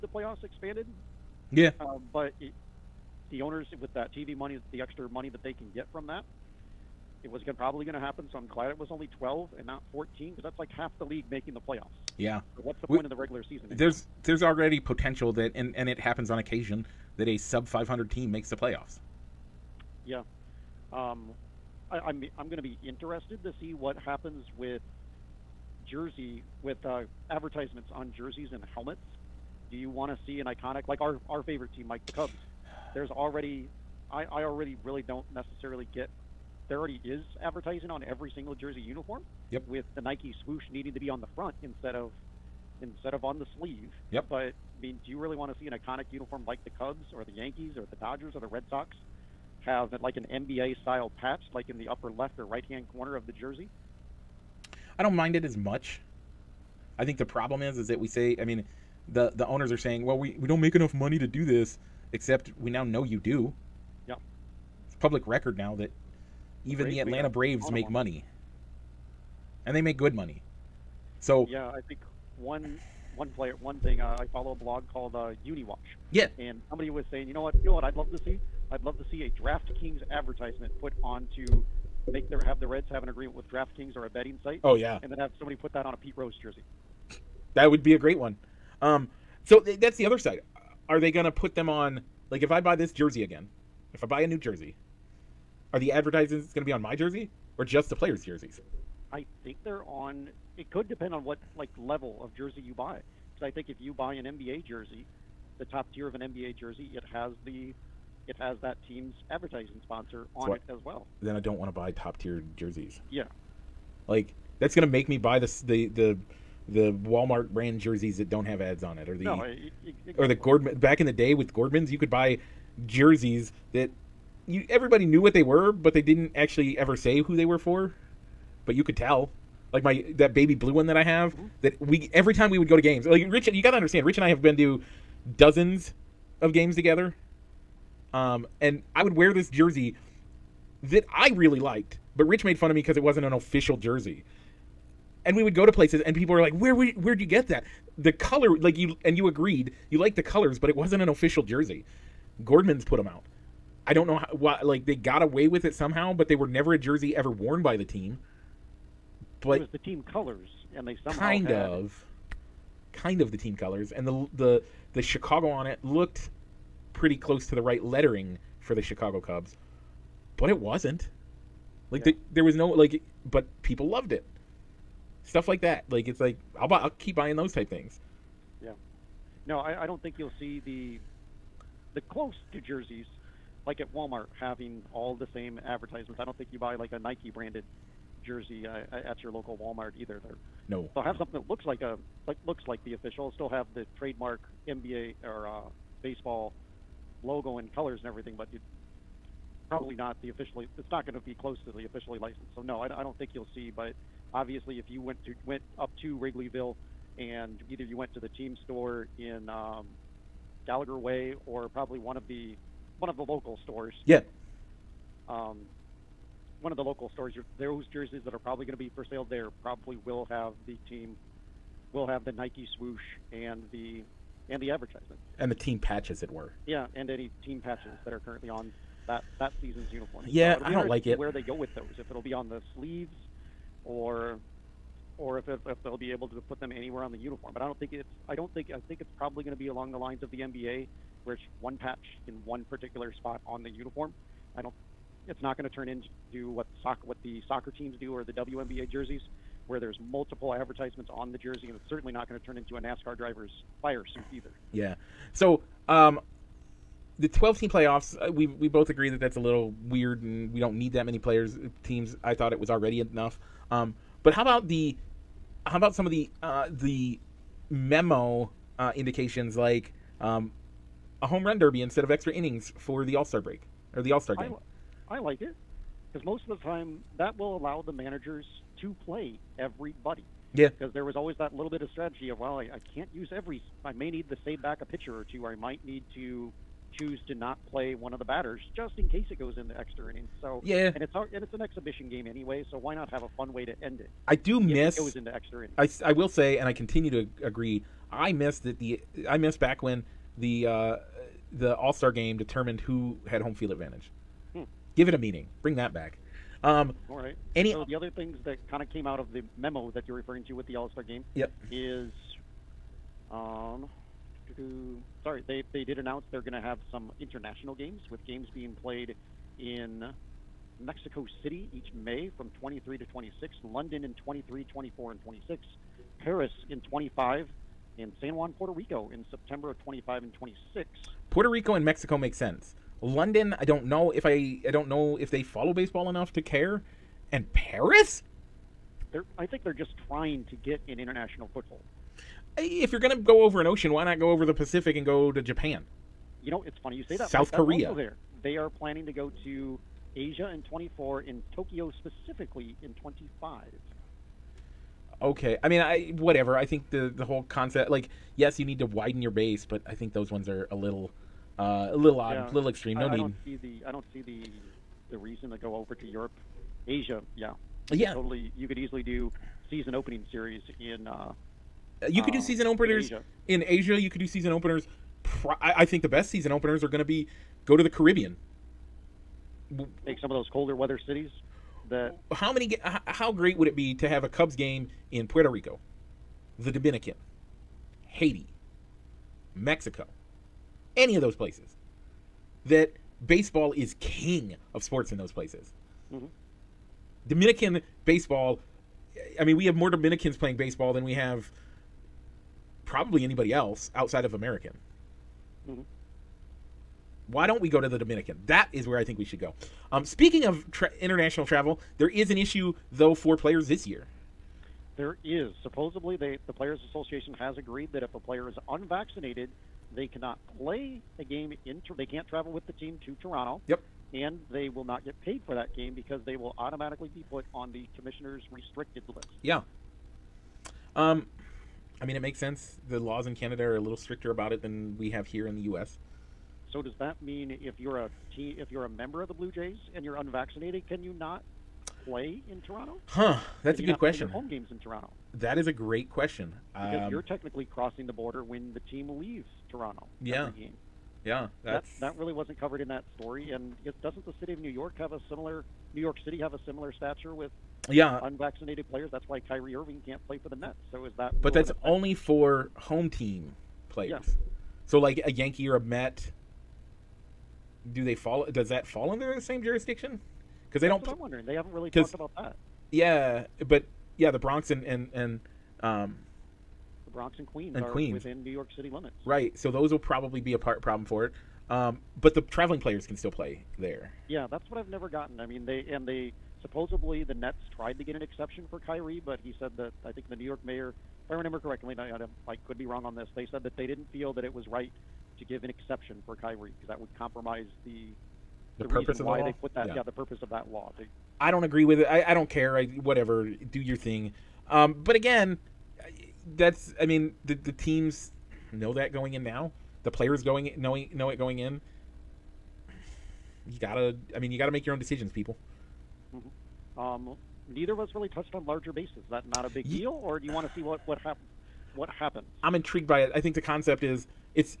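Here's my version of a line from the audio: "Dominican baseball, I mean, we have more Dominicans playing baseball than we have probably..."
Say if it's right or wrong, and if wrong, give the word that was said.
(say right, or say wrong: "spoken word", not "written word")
right.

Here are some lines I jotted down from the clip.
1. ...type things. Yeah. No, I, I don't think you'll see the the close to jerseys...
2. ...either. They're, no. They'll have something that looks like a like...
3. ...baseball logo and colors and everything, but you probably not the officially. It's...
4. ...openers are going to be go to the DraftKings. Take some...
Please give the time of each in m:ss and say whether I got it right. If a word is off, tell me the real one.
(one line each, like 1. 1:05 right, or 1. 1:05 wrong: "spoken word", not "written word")
1. 2:57 right
2. 3:09 right
3. 3:16 right
4. 6:16 wrong: "Caribbean", not "DraftKings".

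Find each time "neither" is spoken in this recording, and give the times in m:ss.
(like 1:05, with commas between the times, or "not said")
8:37.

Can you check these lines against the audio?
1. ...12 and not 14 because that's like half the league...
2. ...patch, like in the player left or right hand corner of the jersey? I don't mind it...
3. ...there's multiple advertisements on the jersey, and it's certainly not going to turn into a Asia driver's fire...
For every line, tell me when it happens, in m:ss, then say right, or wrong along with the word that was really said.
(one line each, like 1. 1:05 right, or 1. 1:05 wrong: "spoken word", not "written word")
1. 0:09 right
2. 0:51 wrong: "upper", not "player"
3. 4:09 wrong: "NASCAR", not "Asia".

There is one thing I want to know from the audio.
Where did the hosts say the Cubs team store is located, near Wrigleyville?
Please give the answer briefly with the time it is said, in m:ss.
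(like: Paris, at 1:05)
Gallagher Way, at 3:30.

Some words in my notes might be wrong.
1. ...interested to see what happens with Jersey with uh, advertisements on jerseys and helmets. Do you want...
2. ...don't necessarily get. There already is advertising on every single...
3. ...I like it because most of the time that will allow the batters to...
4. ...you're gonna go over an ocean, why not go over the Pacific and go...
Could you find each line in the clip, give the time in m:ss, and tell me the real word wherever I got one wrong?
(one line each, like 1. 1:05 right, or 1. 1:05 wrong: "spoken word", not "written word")
1. 0:22 right
2. 0:35 right
3. 4:35 wrong: "managers", not "batters"
4. 5:42 right.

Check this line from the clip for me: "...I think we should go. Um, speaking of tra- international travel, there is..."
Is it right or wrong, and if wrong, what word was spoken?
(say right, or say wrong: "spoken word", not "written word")
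right.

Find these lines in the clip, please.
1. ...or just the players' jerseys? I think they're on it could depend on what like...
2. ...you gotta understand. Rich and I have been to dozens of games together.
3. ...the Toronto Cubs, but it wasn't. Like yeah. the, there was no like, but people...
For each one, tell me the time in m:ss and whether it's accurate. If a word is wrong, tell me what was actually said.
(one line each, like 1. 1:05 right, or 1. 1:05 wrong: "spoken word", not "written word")
1. 1:37 right
2. 2:13 right
3. 2:48 wrong: "Chicago", not "Toronto".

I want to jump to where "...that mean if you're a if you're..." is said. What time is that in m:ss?
7:16.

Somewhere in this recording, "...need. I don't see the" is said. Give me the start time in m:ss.
6:03.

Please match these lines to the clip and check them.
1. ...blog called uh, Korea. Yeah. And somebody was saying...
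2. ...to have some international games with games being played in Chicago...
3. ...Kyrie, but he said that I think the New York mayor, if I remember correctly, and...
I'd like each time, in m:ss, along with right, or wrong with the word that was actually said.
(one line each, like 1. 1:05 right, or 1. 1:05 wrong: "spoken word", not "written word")
1. 1:14 wrong: "UniWatch", not "Korea"
2. 5:16 wrong: "Mexico", not "Chicago"
3. 8:08 right.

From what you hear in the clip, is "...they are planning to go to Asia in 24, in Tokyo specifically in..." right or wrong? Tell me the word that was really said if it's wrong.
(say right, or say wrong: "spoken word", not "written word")
right.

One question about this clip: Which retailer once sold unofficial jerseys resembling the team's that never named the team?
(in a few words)
Gordmans.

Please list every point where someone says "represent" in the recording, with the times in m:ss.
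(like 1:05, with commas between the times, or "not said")
not said.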